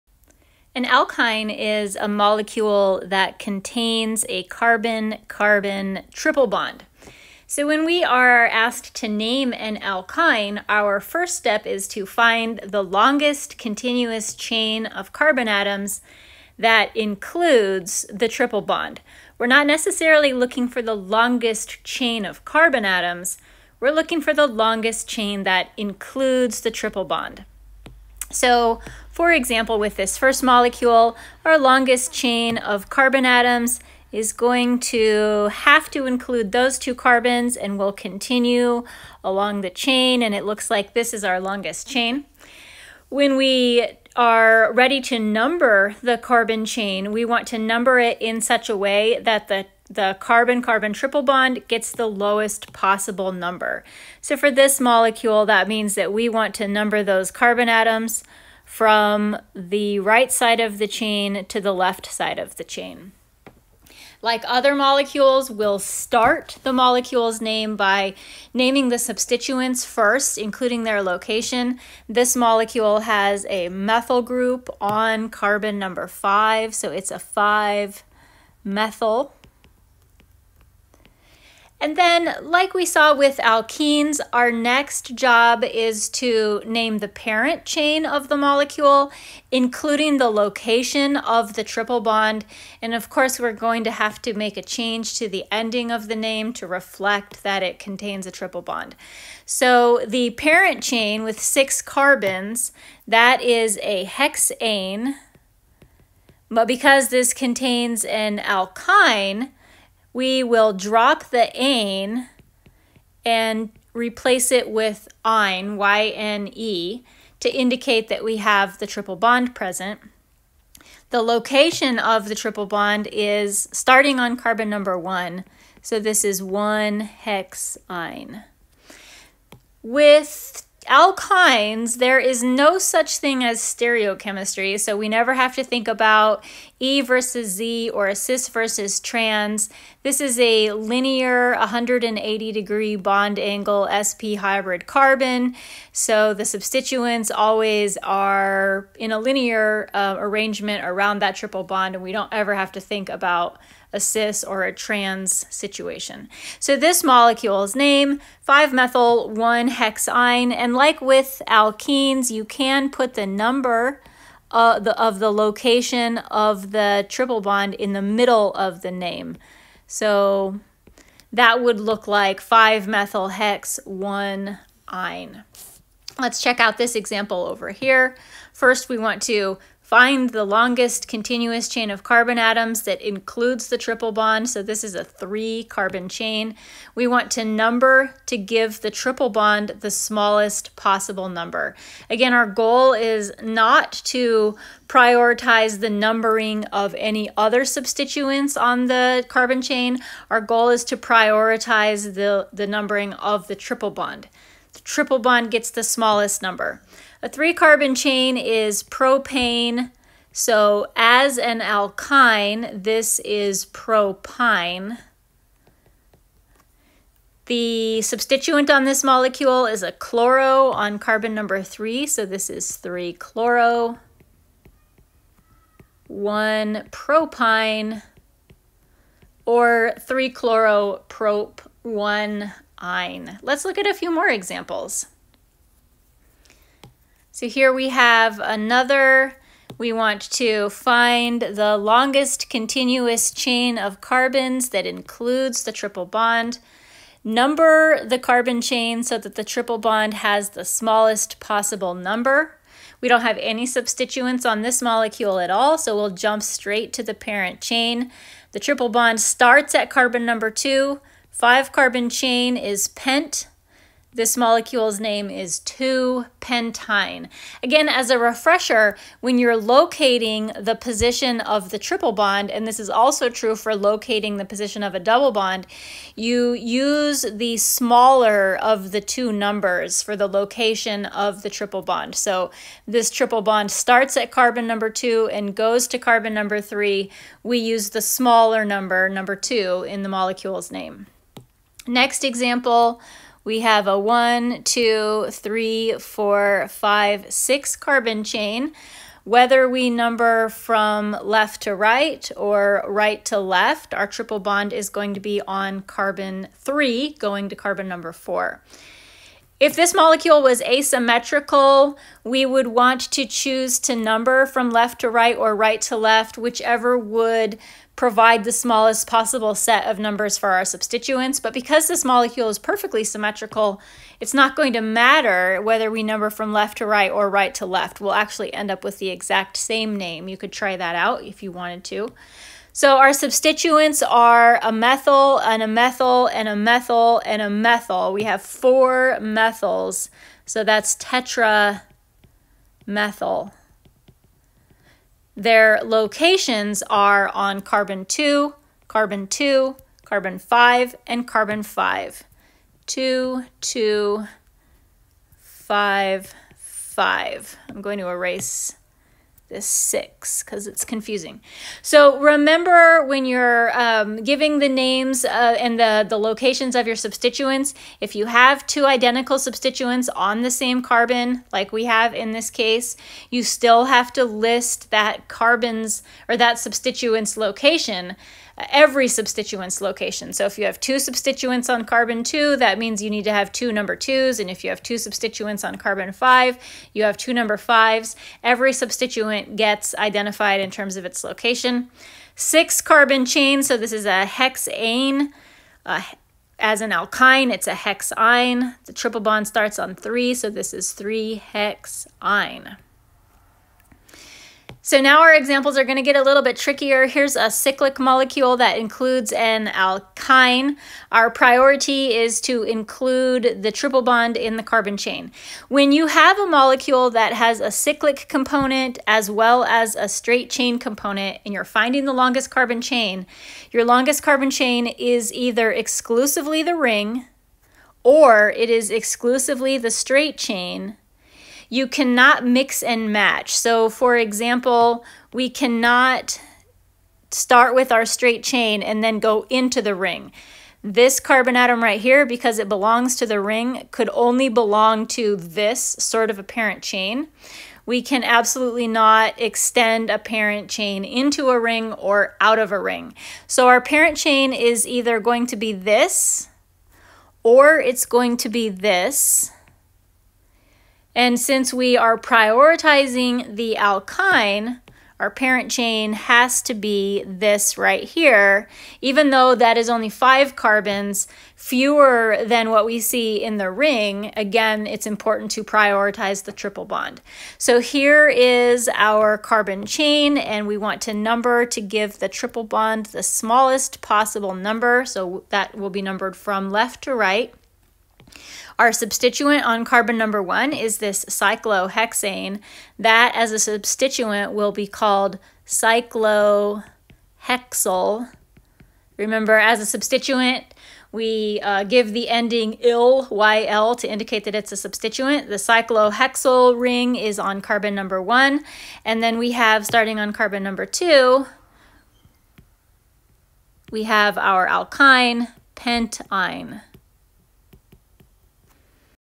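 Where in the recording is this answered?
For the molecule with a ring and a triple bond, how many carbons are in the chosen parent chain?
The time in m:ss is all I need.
7:50.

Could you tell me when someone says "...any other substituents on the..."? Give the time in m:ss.
3:16.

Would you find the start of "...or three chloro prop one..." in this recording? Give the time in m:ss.
3:49.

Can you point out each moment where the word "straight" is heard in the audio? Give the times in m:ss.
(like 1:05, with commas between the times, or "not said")
4:16, 7:00, 7:09, 7:18.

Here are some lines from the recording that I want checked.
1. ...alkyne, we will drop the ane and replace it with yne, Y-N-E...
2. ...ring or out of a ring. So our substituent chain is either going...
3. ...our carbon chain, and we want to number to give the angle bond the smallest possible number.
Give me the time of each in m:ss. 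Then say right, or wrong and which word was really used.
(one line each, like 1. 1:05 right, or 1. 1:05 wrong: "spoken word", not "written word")
1. 1:48 right
2. 7:31 wrong: "parent", not "substituent"
3. 7:58 wrong: "triple", not "angle".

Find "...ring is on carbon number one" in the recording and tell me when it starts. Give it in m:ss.
8:26.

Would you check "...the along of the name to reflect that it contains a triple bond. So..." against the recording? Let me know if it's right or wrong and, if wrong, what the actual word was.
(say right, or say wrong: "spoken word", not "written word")
wrong: "ending", not "along".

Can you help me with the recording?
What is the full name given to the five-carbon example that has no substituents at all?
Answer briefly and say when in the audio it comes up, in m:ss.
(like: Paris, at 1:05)
2-pentyne, at 4:25.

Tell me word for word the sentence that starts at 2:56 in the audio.
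Let's check out this example over here.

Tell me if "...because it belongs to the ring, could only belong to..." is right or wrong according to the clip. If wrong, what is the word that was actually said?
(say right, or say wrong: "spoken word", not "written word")
right.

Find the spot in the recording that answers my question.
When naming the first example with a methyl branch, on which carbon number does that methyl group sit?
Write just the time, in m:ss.
1:15.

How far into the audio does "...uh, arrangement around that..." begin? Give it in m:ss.
2:29.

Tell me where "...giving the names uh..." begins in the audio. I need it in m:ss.
6:04.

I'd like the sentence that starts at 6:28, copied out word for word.
Every substituent gets identified in terms of its location.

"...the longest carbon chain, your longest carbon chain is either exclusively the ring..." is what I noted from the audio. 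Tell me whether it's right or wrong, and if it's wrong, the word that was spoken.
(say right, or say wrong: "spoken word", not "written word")
right.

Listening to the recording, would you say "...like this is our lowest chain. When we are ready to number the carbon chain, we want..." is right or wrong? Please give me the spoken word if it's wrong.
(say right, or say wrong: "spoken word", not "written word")
wrong: "longest", not "lowest".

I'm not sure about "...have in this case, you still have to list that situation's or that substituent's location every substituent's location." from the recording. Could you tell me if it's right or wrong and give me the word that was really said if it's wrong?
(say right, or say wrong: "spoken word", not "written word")
wrong: "carbon", not "situation".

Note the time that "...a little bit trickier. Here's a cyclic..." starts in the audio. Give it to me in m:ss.
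6:46.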